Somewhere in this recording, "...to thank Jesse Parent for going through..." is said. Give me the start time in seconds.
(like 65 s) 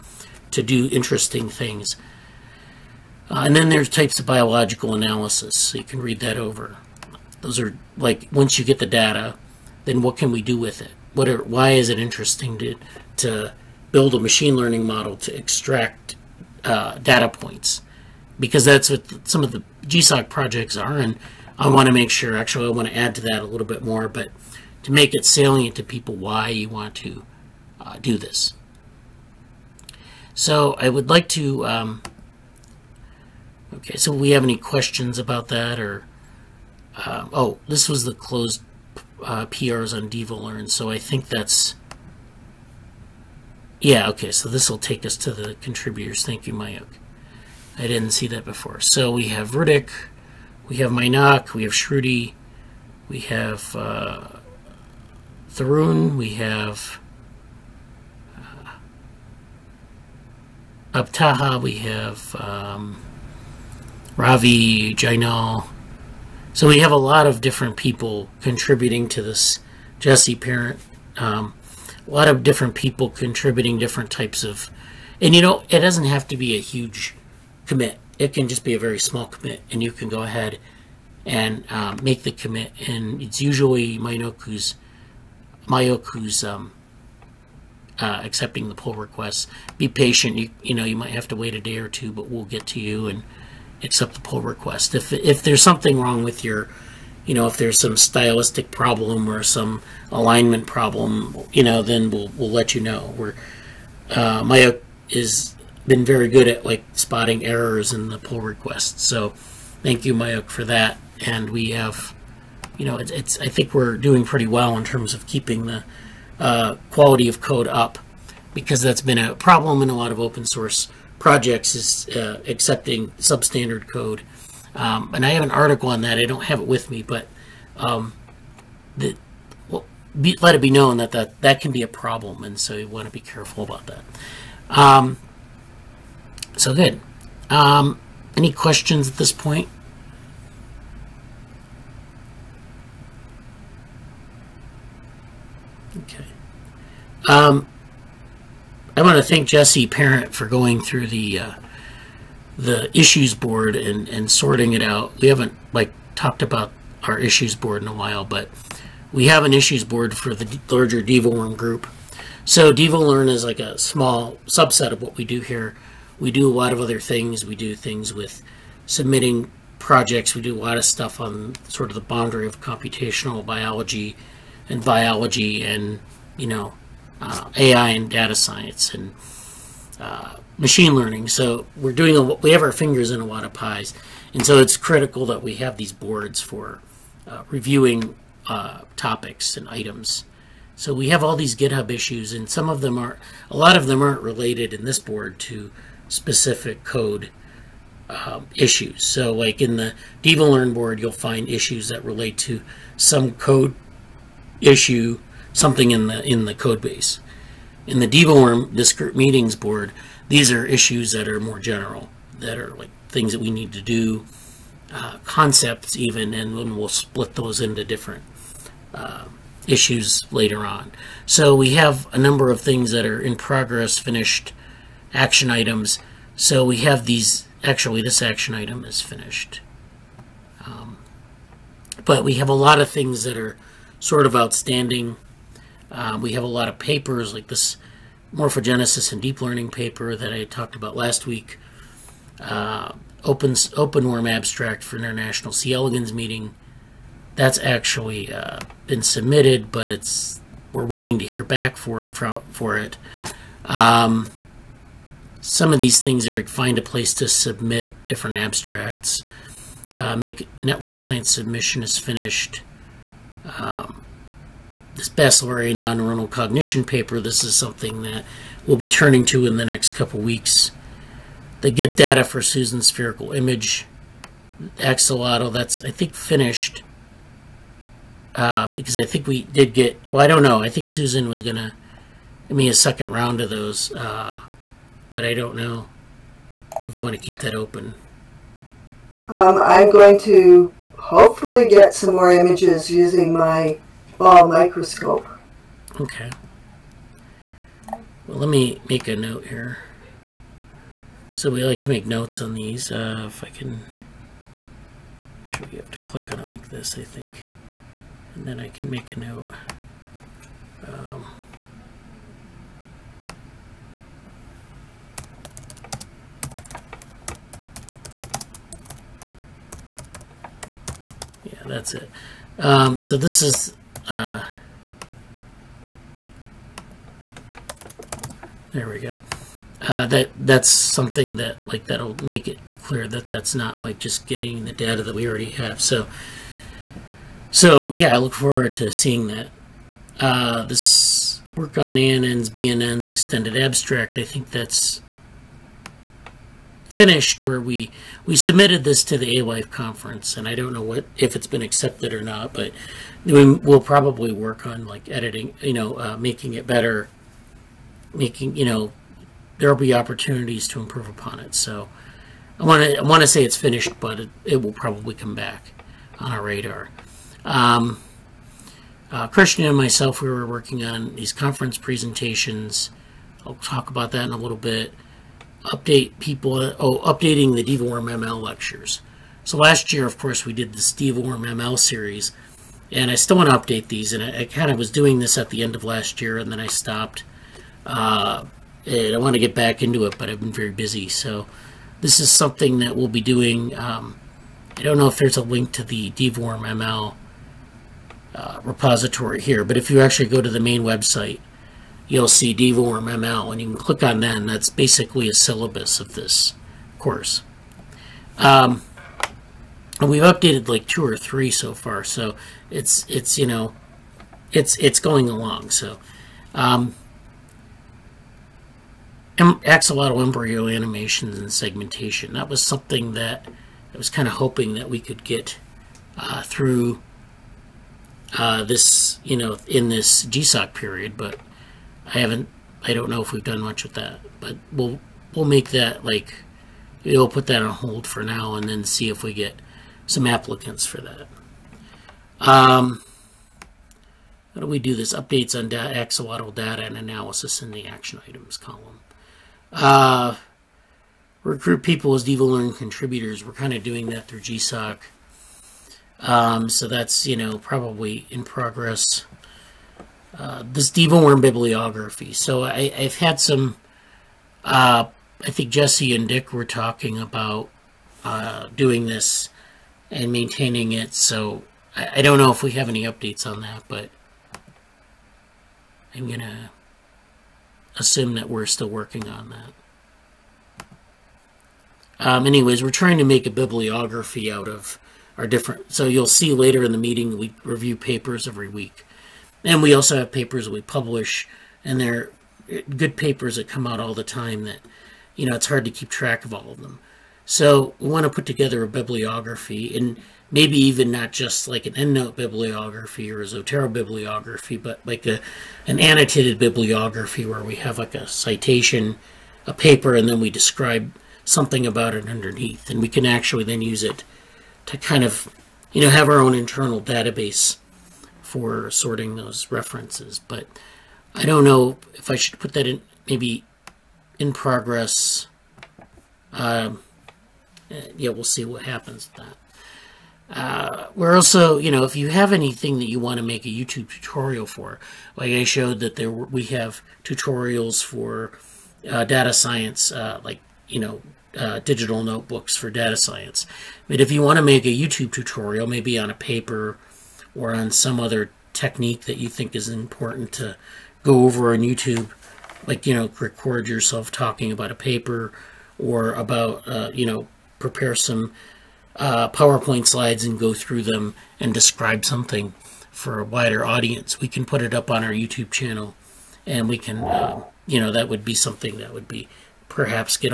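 149 s.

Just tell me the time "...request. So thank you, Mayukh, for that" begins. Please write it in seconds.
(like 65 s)
108 s.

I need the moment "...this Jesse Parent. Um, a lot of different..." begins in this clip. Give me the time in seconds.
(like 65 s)
69 s.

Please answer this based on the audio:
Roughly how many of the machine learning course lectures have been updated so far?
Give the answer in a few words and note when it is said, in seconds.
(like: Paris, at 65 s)
2 or 3, at 410 s.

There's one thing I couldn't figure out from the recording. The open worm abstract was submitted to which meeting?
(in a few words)
International C. elegans meeting.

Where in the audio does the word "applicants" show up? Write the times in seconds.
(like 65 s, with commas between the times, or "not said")
440 s.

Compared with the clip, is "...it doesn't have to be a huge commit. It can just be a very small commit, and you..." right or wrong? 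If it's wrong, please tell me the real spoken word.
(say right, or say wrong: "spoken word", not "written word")
right.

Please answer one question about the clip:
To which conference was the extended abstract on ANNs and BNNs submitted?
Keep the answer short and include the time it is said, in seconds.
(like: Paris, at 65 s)
A-Life conference, at 349 s.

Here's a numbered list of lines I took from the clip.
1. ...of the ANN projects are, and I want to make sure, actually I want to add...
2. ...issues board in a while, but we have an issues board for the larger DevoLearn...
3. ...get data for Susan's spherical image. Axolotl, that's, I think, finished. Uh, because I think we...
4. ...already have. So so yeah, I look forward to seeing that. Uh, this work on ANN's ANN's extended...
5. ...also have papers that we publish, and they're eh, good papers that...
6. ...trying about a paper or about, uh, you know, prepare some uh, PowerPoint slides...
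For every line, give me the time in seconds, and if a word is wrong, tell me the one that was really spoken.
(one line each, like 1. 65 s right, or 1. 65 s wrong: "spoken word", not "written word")
1. 19 s wrong: "GSOC", not "ANN"
2. 157 s right
3. 271 s right
4. 335 s wrong: "BNN", not "ANN"
5. 489 s right
6. 554 s wrong: "talking", not "trying".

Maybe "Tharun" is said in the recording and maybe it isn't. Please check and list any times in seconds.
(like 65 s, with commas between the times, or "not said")
55 s.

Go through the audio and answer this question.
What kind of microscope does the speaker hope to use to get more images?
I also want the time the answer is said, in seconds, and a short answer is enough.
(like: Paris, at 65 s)
Oh microscope, at 294 s.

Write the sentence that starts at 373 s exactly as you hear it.
I'll talk about that in a little bit update people, oh, updating the DeepWorm ML lectures.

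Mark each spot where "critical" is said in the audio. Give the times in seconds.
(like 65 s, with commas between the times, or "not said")
184 s.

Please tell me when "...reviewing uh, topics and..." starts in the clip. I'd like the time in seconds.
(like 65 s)
187 s.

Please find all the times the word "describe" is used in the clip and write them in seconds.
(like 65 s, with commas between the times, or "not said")
510 s, 561 s.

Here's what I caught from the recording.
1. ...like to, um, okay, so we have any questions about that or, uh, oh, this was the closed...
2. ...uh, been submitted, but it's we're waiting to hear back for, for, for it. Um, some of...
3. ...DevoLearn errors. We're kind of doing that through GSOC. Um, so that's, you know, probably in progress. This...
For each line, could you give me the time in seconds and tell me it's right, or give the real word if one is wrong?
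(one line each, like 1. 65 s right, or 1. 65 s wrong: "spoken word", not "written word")
1. 31 s right
2. 248 s right
3. 452 s wrong: "contributors", not "errors".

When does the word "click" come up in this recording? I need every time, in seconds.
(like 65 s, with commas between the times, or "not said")
305 s, 403 s.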